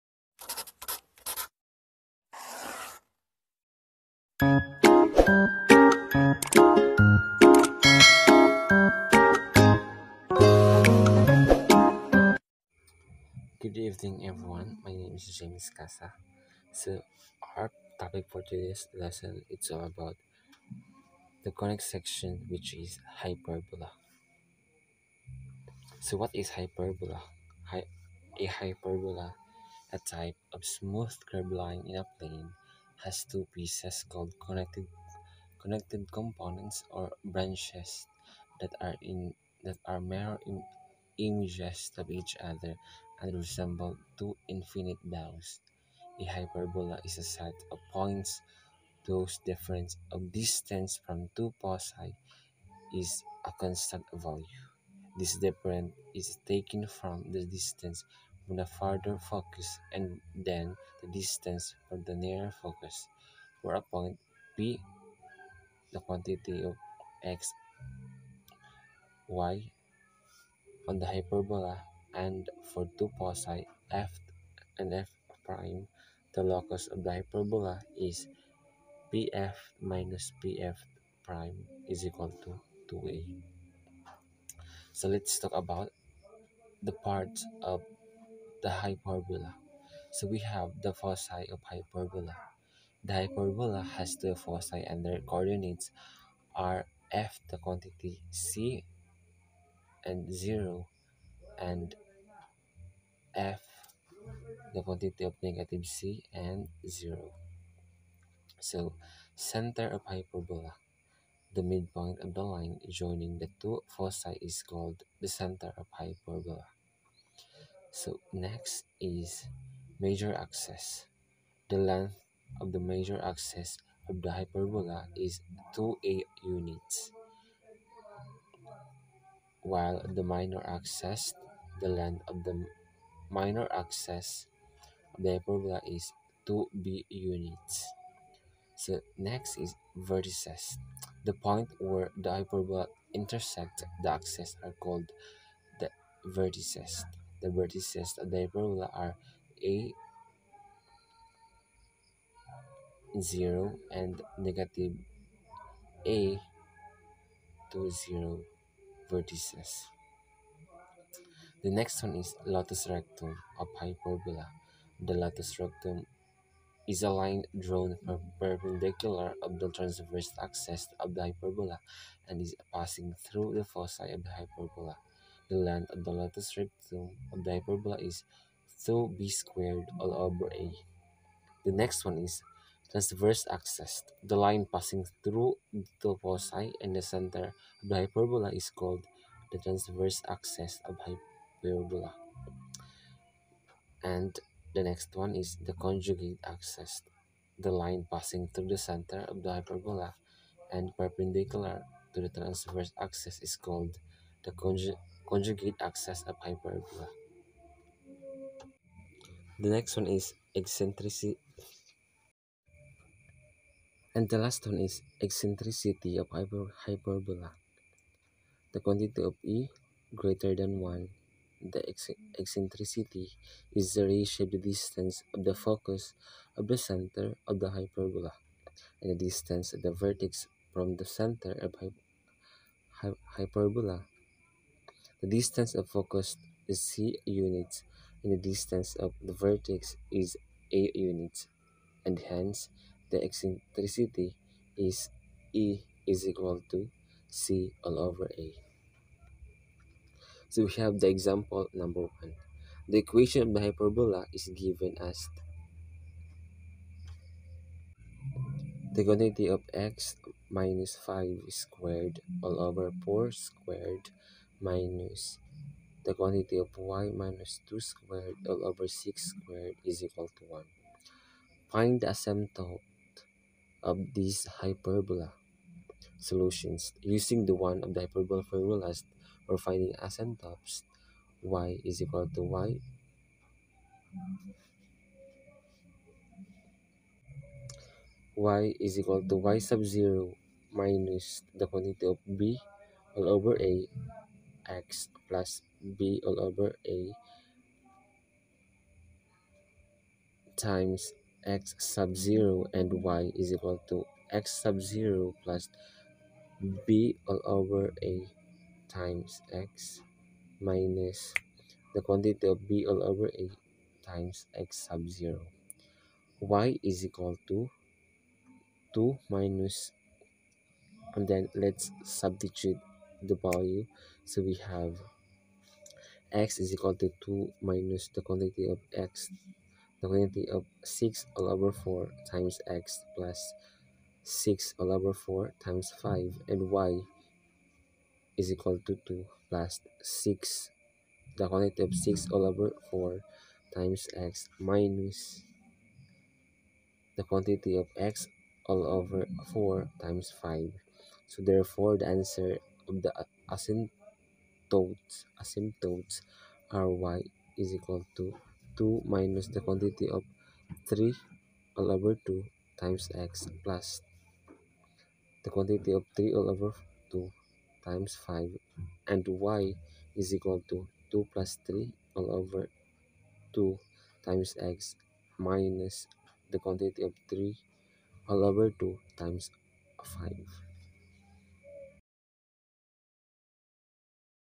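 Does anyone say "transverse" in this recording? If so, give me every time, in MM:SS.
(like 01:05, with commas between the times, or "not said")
02:49, 03:02, 03:09, 03:22.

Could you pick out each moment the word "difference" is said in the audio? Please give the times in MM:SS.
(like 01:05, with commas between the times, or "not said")
00:49, 00:55.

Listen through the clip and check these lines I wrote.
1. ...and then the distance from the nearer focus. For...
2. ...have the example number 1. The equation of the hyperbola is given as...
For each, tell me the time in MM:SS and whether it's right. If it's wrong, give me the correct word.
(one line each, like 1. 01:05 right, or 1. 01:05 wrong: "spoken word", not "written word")
1. 00:59 right
2. 04:10 right.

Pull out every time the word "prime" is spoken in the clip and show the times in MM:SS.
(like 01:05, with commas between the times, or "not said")
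01:15, 01:21.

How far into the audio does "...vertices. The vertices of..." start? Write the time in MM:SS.
02:26.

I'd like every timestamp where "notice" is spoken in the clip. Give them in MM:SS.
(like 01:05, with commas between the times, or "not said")
not said.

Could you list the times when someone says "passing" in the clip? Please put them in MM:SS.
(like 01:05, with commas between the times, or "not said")
02:52, 03:04, 03:18.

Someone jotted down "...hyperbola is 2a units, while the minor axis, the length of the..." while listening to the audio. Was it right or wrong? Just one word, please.
right.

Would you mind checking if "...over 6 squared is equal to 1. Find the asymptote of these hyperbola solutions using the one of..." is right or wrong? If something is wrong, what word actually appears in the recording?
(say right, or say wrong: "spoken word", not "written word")
right.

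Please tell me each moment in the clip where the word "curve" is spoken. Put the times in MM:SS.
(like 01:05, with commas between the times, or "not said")
00:31.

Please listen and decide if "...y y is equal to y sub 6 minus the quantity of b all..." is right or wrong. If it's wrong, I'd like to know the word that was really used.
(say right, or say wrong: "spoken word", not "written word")
wrong: "0", not "6".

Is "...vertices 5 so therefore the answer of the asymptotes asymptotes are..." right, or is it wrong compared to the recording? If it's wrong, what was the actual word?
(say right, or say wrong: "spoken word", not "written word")
wrong: "times", not "vertices".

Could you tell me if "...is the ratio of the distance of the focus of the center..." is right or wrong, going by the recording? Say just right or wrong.
right.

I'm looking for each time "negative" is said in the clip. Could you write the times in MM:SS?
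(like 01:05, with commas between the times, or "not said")
01:45, 02:34.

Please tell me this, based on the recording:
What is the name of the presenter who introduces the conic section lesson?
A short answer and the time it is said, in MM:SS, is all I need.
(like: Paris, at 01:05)
James Casa, at 00:15.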